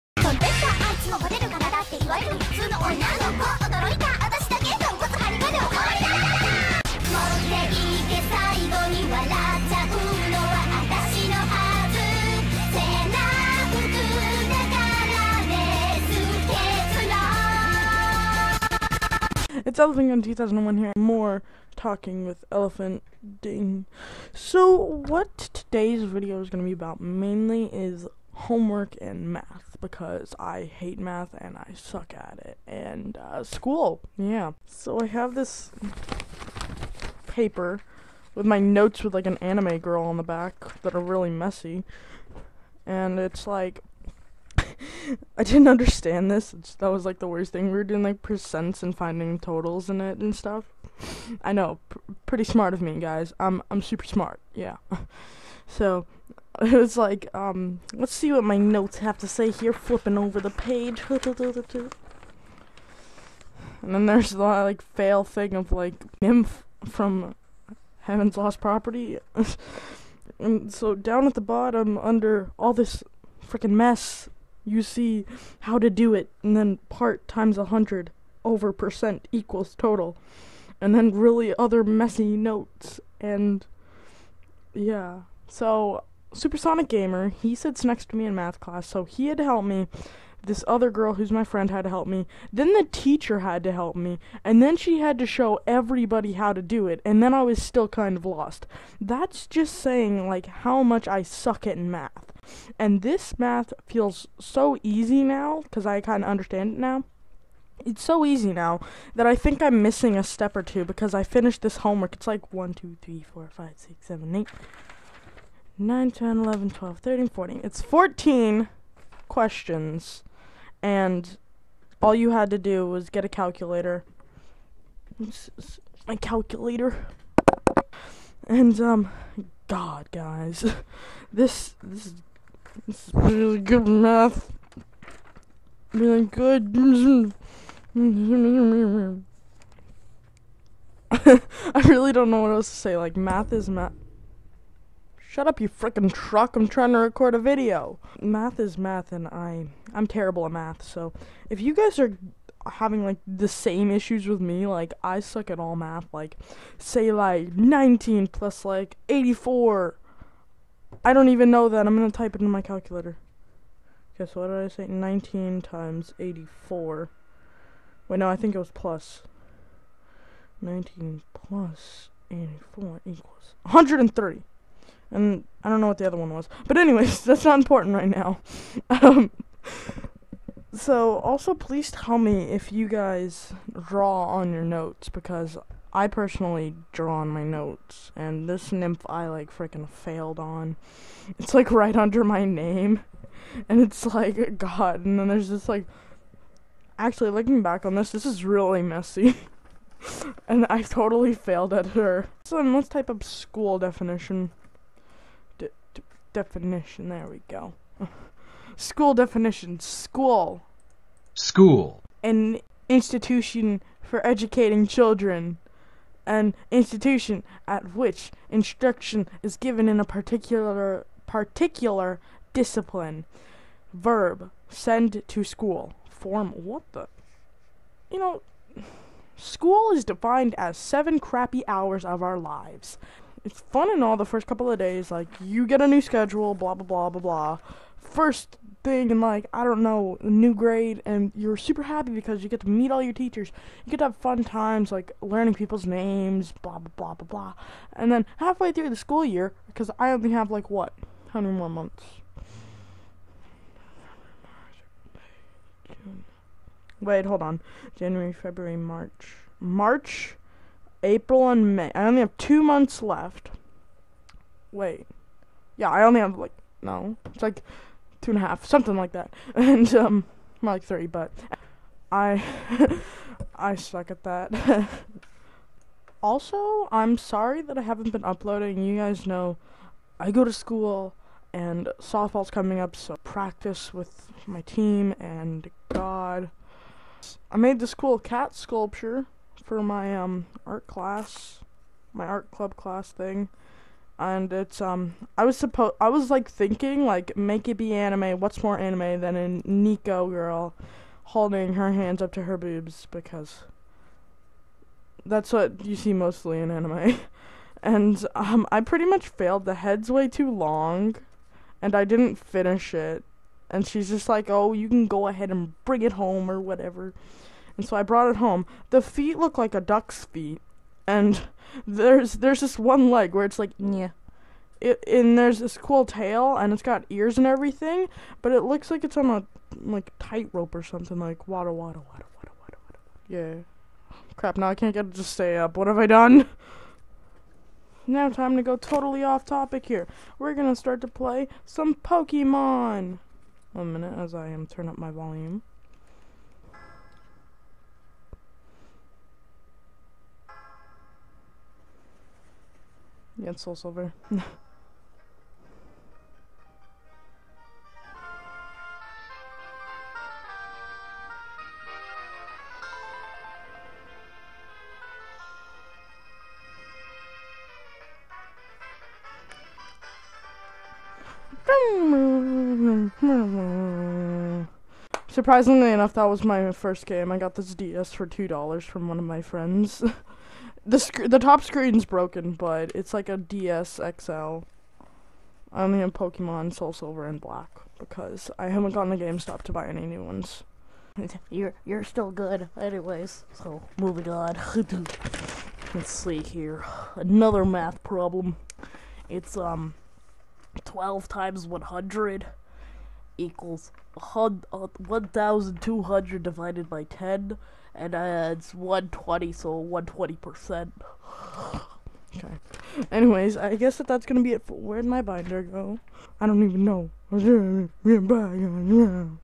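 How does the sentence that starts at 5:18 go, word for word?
The feet look like a duck's feet.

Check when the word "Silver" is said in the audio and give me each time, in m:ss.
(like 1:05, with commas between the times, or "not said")
5:53, 6:26.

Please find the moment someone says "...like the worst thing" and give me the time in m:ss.
0:47.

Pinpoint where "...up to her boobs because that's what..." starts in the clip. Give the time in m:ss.
5:02.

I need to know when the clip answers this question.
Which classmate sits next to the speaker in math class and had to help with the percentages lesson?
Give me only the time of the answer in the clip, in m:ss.
1:26.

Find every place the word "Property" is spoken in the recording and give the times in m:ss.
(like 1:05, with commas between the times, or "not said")
1:08.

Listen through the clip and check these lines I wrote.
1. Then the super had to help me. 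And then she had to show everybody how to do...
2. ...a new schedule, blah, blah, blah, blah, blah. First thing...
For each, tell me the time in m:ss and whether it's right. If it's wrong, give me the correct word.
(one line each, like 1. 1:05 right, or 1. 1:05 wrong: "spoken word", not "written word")
1. 1:32 wrong: "teacher", not "super"
2. 3:55 right.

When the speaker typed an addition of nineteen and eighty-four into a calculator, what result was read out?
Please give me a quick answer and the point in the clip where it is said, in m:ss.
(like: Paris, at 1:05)
130, at 2:53.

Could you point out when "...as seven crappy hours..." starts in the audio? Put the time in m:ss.
3:50.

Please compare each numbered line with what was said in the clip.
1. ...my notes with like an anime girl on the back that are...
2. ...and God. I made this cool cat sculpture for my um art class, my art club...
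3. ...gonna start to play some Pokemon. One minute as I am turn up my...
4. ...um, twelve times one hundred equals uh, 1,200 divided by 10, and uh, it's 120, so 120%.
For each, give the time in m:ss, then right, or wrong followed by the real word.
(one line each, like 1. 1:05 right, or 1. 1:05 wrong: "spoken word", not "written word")
1. 0:38 right
2. 4:45 right
3. 5:40 right
4. 6:39 right.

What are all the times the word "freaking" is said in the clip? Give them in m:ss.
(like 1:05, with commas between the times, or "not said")
1:13, 2:25, 3:09.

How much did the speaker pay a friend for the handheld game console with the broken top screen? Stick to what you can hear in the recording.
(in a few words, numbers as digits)
2 dollars.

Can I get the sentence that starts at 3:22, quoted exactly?
So then let's type up school definition.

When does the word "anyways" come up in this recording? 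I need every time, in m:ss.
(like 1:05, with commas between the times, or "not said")
2:56, 6:32, 6:53.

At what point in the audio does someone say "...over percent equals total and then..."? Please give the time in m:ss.
1:18.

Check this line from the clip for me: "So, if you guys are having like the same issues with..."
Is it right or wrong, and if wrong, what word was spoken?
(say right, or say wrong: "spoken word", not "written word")
right.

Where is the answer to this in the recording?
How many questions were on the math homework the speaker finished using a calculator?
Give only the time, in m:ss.
1:57.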